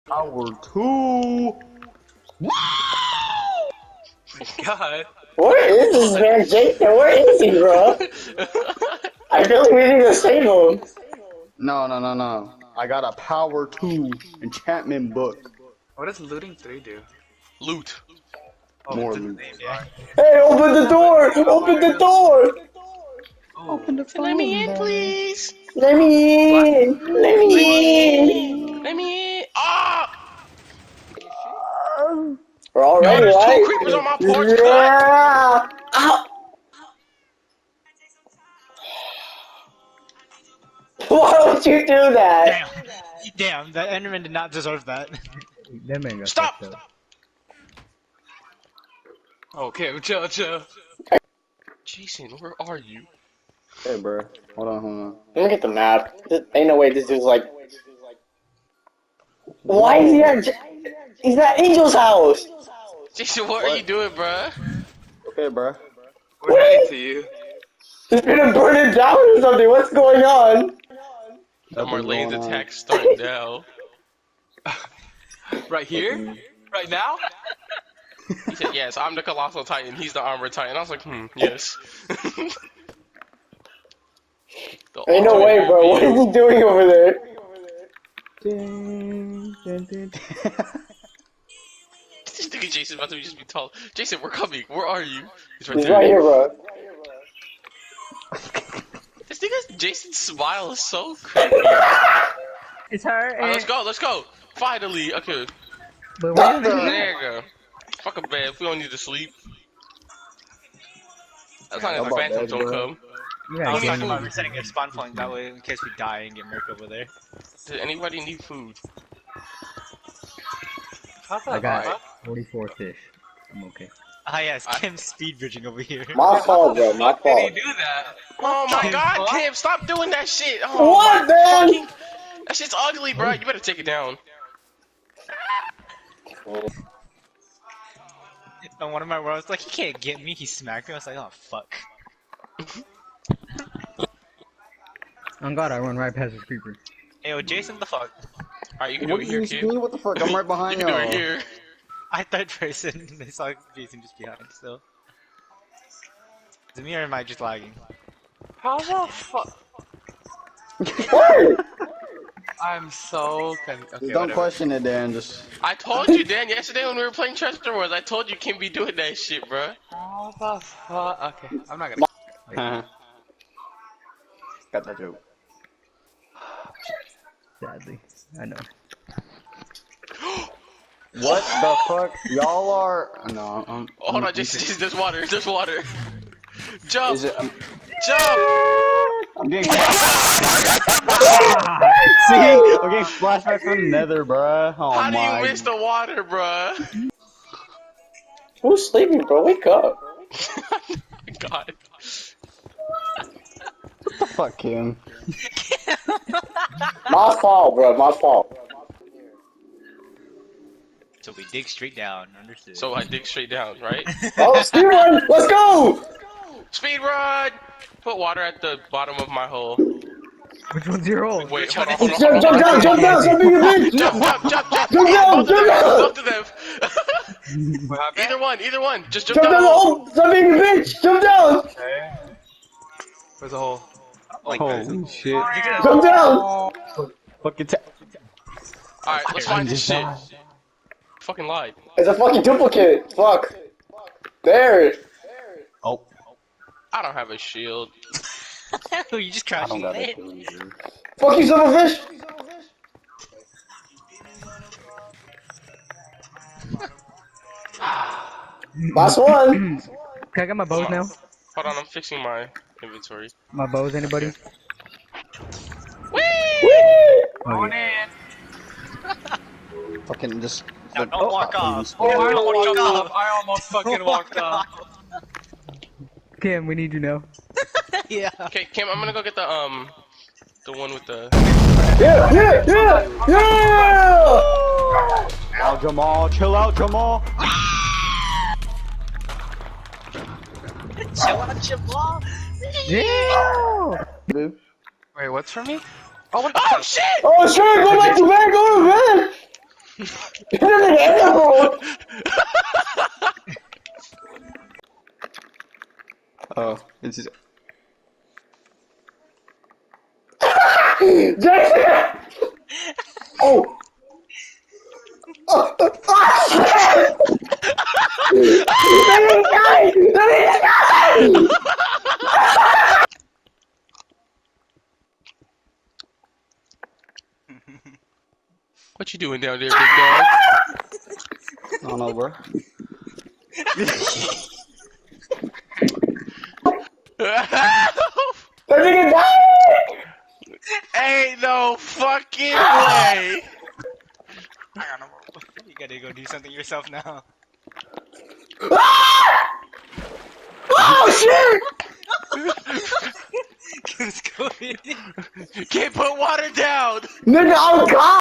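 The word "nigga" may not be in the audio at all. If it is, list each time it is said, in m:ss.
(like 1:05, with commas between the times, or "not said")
1:39, 5:38, 5:57.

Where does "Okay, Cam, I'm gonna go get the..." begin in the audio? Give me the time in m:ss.
4:38.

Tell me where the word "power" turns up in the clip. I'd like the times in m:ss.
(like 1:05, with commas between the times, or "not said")
0:00, 0:13.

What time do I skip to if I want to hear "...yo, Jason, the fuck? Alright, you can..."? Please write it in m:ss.
2:27.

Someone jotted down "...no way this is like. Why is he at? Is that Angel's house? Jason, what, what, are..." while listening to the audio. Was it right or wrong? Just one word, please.
right.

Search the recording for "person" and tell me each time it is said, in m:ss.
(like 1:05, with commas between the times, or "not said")
2:32.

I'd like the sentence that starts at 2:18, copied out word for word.
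On one of my worlds like, he can't get me.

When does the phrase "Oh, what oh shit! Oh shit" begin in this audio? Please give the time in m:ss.
4:56.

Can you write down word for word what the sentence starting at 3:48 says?
Either one, either one, just jump, jump down.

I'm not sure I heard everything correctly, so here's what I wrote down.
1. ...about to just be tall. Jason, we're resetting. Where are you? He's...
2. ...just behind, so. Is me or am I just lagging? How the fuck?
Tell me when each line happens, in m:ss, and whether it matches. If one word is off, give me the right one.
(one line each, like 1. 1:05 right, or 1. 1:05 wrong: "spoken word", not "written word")
1. 1:32 wrong: "coming", not "resetting"
2. 2:34 right.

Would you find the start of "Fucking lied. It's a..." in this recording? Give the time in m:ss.
4:01.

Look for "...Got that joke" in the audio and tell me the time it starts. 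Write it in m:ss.
2:54.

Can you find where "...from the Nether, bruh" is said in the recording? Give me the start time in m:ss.
3:13.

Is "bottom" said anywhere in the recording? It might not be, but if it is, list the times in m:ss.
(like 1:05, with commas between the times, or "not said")
3:38.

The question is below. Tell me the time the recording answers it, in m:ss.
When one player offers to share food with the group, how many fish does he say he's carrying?
2:02.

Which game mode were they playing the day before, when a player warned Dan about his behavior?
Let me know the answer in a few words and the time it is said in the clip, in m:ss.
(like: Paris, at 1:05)
Treasure Wars, at 2:47.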